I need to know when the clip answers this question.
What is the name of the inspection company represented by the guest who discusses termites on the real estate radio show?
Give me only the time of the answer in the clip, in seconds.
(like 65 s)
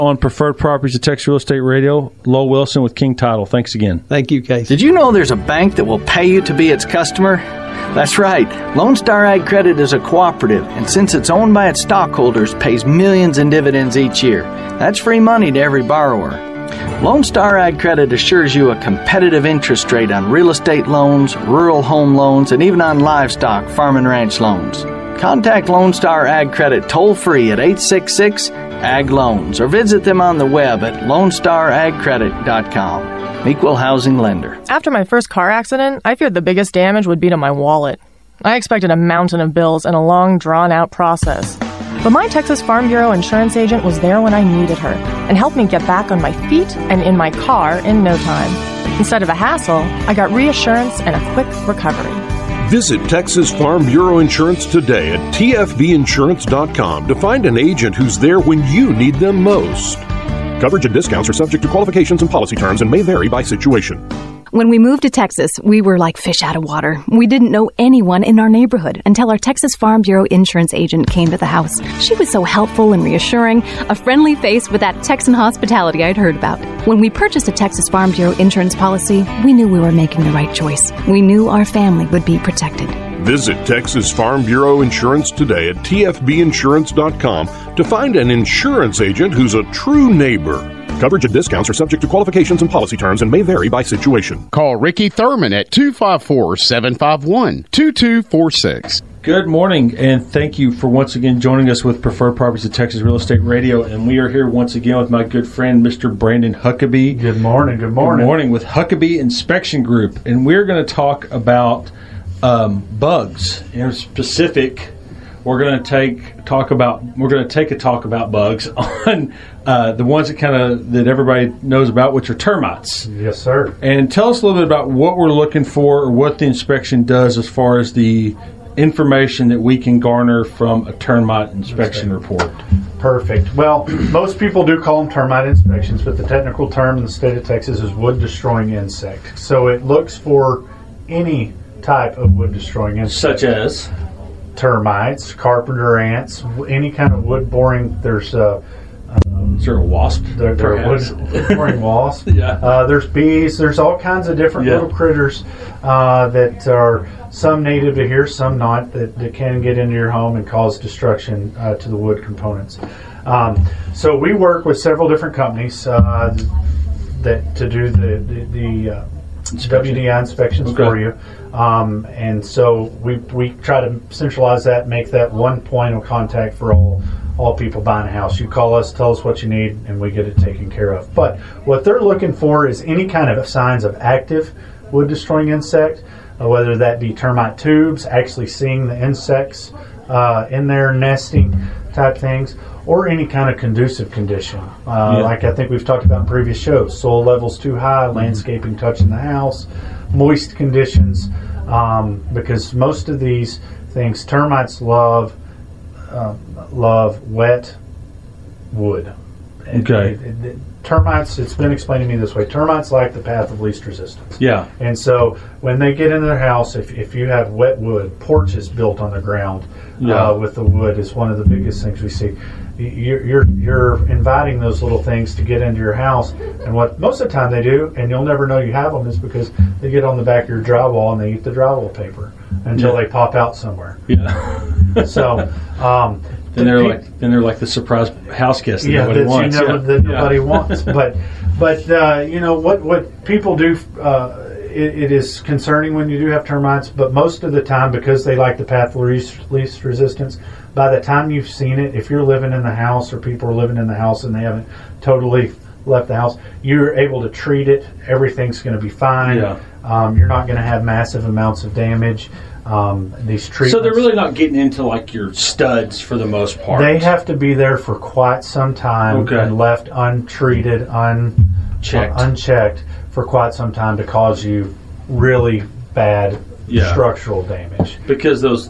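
108 s.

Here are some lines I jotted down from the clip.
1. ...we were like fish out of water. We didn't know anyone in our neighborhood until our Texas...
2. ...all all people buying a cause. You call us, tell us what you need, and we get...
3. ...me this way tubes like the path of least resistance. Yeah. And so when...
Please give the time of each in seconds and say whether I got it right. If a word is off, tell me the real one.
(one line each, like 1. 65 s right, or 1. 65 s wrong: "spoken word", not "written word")
1. 65 s right
2. 176 s wrong: "house", not "cause"
3. 212 s wrong: "termites", not "tubes".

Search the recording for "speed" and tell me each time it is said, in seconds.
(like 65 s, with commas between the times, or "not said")
not said.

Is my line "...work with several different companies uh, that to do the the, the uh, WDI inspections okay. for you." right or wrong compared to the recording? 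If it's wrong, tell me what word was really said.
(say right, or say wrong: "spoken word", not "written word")
right.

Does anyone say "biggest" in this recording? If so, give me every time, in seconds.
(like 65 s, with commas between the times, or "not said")
36 s, 221 s.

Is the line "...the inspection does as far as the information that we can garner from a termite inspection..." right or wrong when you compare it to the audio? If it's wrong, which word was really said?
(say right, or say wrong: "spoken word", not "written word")
right.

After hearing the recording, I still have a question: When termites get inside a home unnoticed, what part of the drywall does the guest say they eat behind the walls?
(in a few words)
drywall paper.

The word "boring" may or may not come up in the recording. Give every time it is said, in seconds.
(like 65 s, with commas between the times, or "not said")
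147 s, 151 s.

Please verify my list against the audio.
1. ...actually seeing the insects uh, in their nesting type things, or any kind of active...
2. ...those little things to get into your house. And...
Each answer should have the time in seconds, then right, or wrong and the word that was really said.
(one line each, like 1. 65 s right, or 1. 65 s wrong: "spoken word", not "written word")
1. 188 s wrong: "conducive", not "active"
2. 224 s right.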